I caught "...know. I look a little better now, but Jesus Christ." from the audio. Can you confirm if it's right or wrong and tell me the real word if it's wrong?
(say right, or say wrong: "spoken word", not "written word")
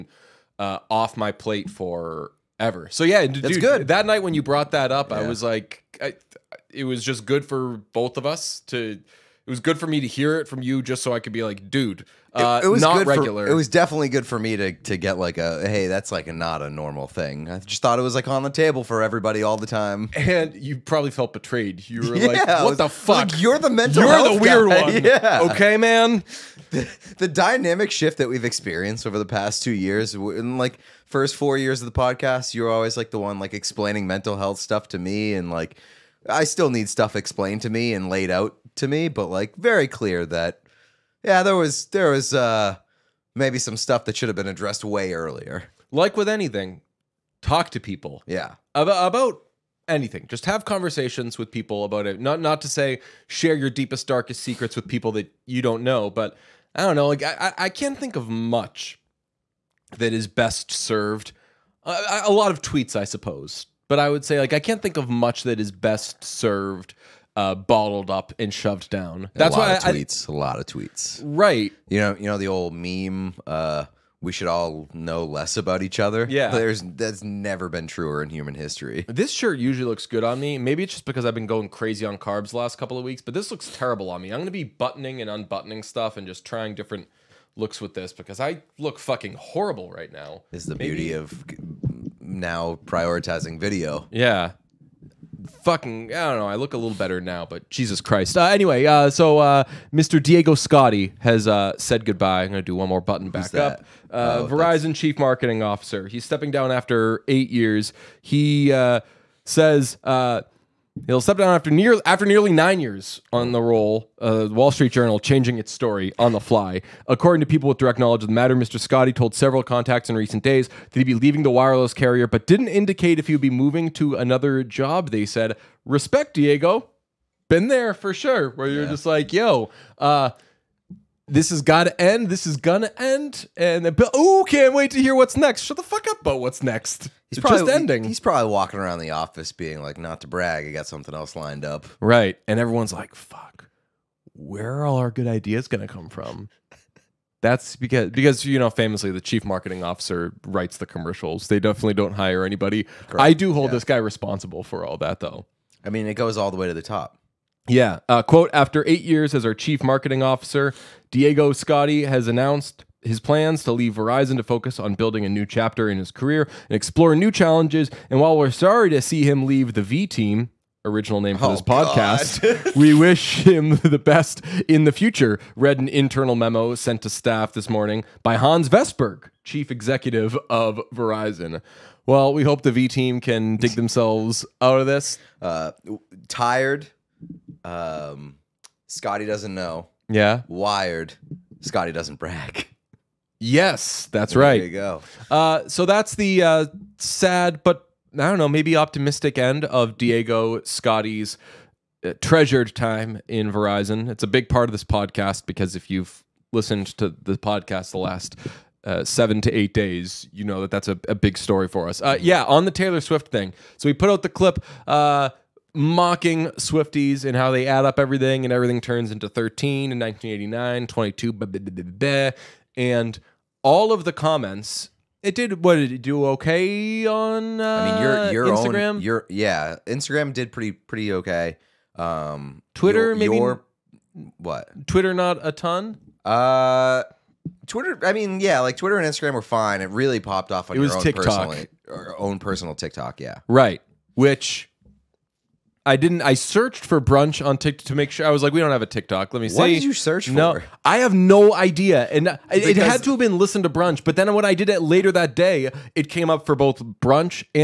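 right.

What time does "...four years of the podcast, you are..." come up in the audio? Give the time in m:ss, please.
0:31.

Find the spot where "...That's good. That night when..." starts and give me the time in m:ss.
0:03.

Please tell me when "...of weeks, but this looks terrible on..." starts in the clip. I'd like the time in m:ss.
1:22.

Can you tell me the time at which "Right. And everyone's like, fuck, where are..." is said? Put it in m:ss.
2:21.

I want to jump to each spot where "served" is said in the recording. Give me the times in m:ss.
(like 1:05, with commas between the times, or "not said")
1:00, 1:06.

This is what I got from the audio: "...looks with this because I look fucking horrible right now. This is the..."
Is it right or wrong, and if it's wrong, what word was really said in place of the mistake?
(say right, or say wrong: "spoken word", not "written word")
right.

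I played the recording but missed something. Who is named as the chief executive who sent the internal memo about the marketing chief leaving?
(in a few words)
Hans Vestberg.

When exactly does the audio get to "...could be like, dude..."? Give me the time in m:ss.
0:11.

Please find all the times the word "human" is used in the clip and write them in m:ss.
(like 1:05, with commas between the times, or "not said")
1:18.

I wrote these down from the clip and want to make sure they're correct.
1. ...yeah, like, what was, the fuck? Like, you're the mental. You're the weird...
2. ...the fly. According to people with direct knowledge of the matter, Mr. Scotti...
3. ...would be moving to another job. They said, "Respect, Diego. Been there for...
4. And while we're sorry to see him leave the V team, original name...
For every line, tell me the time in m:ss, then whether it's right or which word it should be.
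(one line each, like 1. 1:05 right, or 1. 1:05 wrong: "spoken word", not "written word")
1. 0:22 right
2. 1:56 right
3. 2:03 right
4. 2:48 right.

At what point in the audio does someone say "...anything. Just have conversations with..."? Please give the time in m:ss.
0:49.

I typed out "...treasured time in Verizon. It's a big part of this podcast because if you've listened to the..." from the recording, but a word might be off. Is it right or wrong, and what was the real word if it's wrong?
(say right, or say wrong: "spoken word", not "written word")
right.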